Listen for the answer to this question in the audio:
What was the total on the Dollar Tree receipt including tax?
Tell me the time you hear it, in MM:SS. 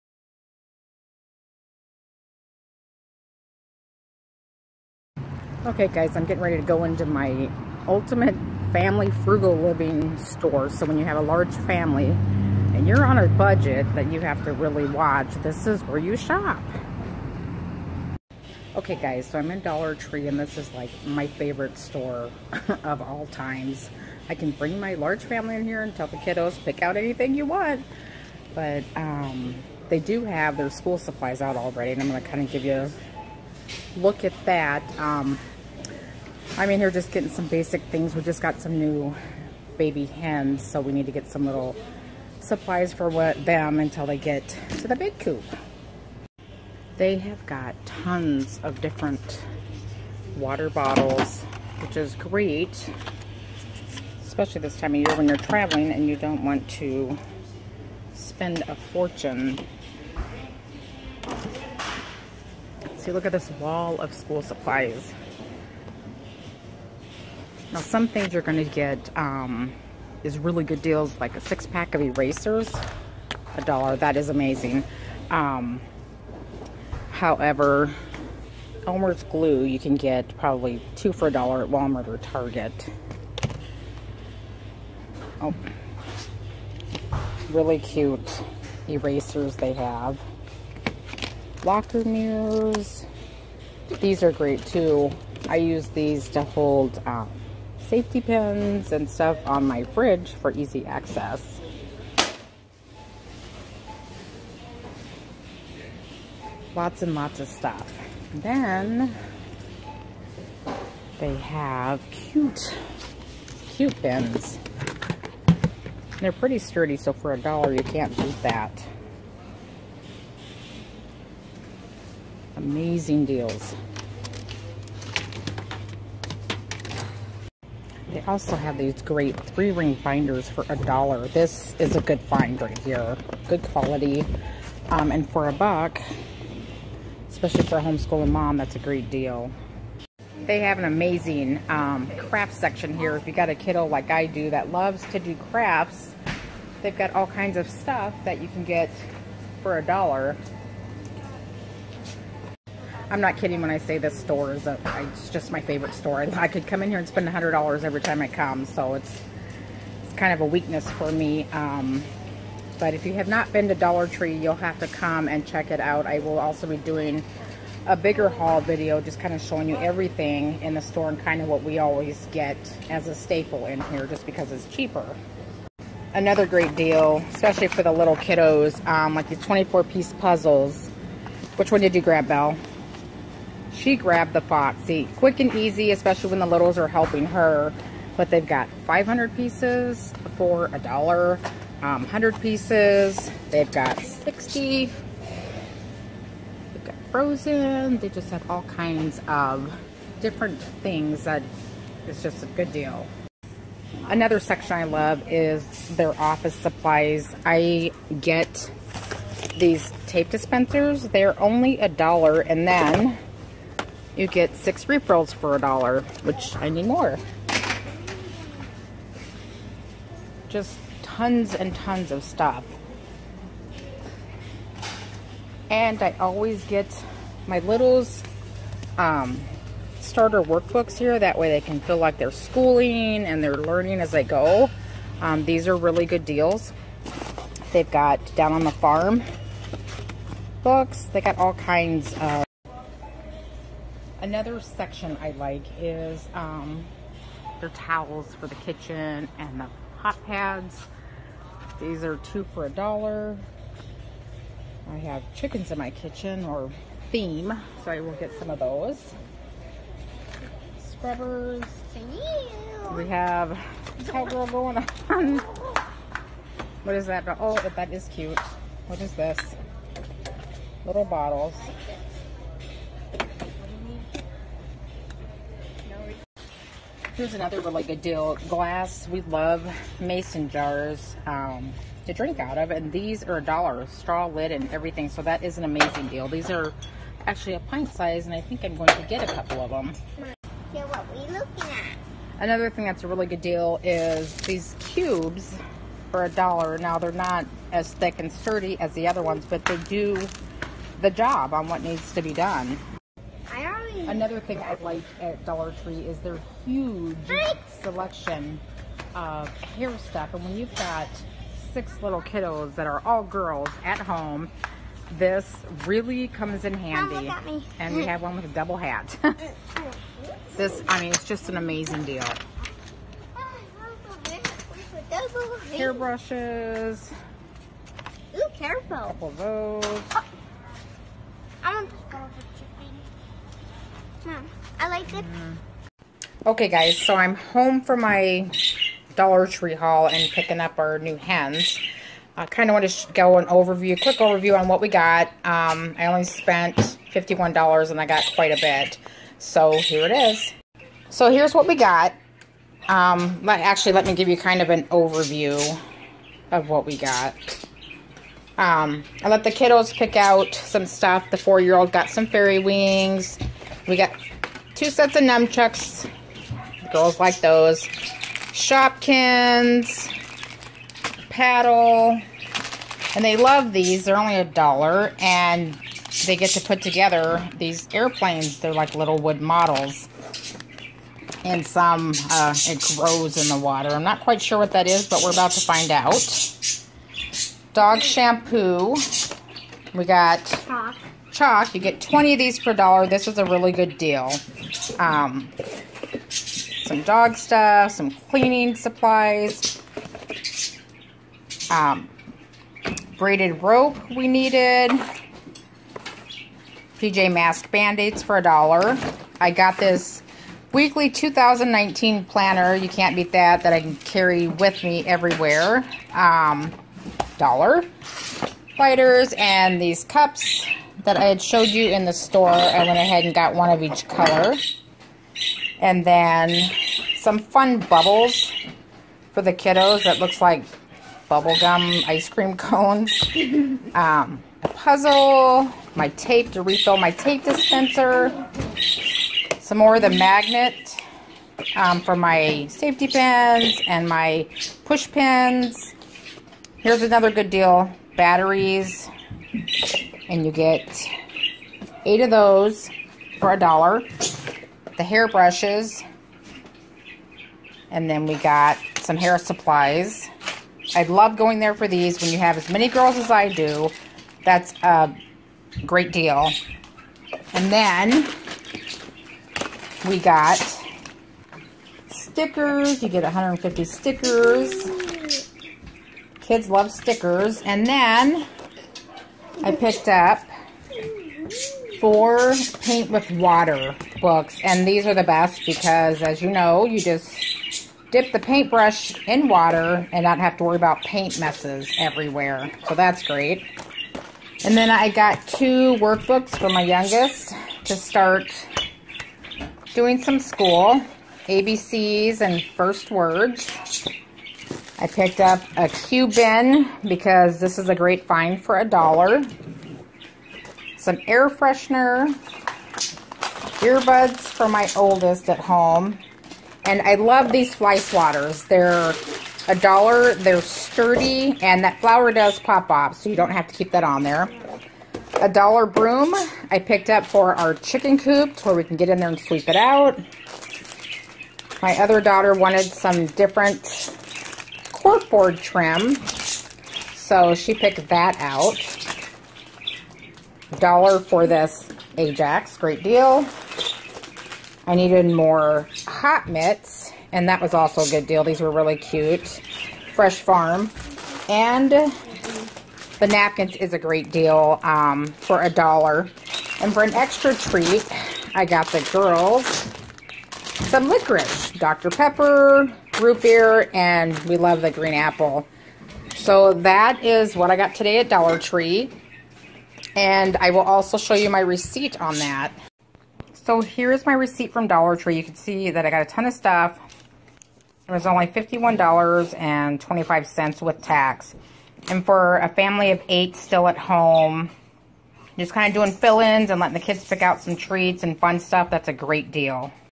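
09:38.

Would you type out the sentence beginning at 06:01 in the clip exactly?
The four-year-old got some fairy wings.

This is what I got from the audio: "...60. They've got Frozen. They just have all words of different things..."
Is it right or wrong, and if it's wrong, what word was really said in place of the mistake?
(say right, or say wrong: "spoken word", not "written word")
wrong: "kinds", not "words".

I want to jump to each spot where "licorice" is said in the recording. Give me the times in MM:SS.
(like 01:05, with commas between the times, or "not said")
09:21.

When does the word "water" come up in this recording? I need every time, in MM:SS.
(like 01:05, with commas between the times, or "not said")
00:50, 06:23, 08:03, 08:09.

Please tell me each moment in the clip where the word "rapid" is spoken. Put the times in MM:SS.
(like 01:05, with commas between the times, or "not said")
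not said.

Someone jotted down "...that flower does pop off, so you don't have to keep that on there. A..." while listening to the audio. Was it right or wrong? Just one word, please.
right.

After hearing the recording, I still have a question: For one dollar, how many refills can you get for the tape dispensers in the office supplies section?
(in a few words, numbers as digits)
6.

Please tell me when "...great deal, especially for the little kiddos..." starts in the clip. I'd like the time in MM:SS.
02:56.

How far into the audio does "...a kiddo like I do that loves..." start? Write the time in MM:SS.
02:23.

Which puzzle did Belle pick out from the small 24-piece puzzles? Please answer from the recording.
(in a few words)
Foxy.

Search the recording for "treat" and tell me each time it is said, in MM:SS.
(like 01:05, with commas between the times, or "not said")
09:17, 09:47.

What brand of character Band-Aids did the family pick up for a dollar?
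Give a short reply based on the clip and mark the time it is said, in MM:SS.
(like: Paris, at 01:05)
PJ Mask, at 06:46.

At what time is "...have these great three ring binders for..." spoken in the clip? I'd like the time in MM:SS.
02:08.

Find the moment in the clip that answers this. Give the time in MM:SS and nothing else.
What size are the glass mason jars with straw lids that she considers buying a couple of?
04:47.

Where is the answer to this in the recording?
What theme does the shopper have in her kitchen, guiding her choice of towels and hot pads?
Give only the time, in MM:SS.
04:15.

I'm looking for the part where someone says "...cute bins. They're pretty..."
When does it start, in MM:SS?
01:53.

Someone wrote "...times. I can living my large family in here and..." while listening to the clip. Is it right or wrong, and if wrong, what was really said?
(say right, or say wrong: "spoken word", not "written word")
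wrong: "bring", not "living".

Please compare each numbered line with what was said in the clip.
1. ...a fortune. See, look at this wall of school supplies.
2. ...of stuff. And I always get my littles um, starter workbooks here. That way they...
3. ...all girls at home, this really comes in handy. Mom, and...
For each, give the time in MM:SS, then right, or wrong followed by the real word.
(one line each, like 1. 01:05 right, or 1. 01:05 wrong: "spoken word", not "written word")
1. 00:58 right
2. 03:42 right
3. 05:13 right.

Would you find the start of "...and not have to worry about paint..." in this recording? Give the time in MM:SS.
08:10.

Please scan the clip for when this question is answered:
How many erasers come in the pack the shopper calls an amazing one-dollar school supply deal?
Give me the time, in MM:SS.
01:11.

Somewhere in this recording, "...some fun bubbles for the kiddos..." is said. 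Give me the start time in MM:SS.
07:07.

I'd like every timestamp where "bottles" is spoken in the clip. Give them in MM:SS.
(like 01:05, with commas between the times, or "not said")
00:50, 04:31.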